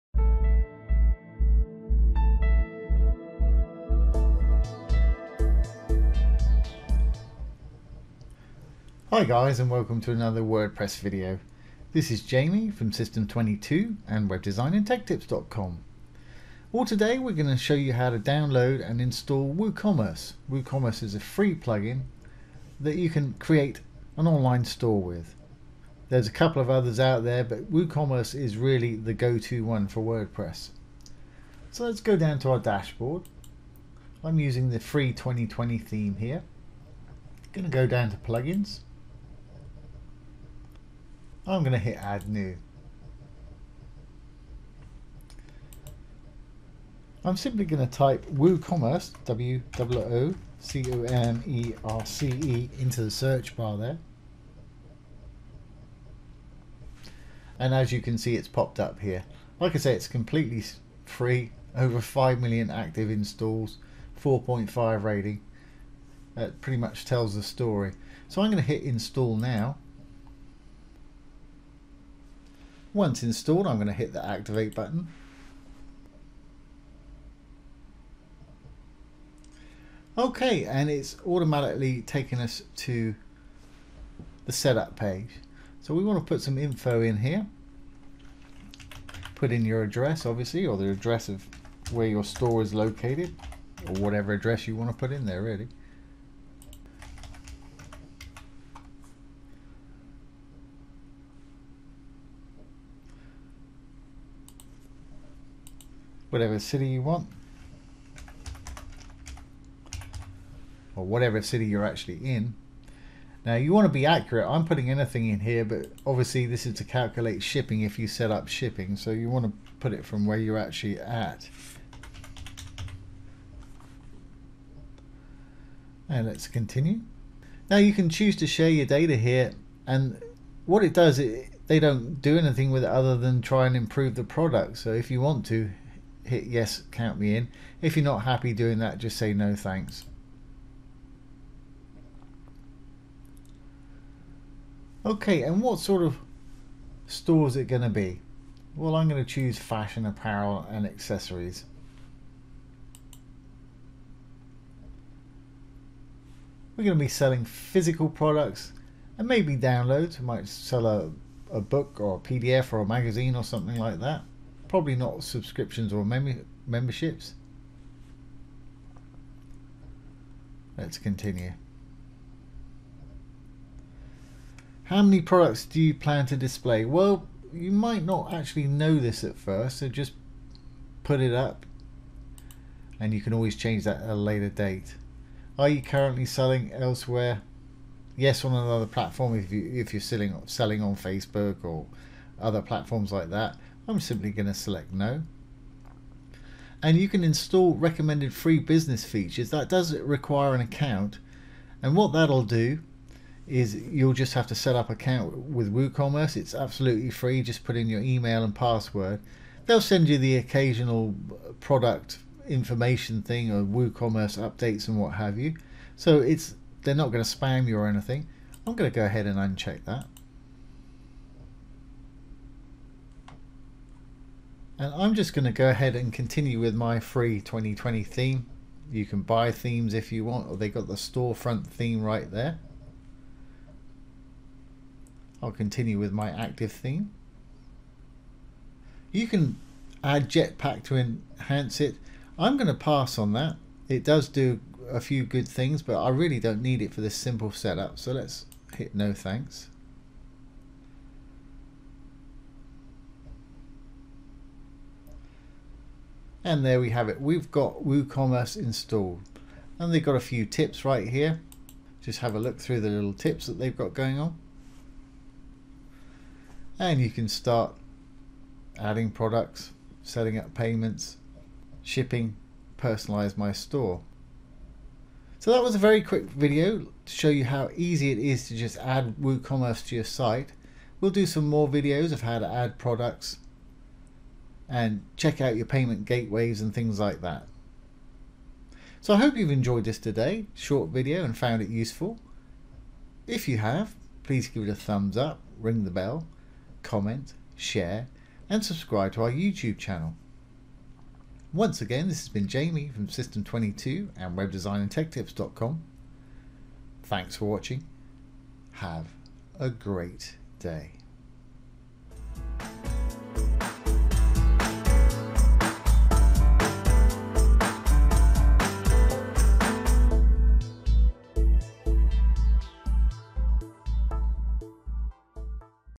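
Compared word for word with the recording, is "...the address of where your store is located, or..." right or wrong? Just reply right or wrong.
right.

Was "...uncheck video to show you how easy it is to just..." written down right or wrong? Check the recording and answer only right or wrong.
wrong.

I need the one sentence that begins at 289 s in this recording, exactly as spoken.
So I hope you've enjoyed this today, short video and found it useful.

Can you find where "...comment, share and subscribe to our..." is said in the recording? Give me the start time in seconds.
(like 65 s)
296 s.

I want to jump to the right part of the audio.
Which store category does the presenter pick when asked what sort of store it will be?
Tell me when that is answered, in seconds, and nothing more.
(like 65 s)
149 s.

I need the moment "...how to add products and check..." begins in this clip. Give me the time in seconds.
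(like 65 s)
282 s.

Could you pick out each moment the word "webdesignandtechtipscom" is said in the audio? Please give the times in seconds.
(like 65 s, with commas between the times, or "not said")
14 s, 304 s.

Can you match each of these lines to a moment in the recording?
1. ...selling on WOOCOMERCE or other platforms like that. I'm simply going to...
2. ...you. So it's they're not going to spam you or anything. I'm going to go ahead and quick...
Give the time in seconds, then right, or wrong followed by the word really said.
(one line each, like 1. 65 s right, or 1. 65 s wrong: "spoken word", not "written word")
1. 190 s wrong: "Facebook", not "WOOCOMERCE"
2. 215 s wrong: "uncheck", not "quick".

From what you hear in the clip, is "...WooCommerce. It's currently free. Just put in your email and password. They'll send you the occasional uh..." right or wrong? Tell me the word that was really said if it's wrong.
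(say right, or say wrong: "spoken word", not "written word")
wrong: "absolutely", not "currently".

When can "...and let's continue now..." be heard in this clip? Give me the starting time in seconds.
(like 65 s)
126 s.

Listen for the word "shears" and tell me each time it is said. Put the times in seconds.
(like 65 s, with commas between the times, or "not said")
not said.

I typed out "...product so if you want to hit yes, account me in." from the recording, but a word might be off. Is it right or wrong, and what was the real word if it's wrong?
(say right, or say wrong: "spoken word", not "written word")
wrong: "count", not "account".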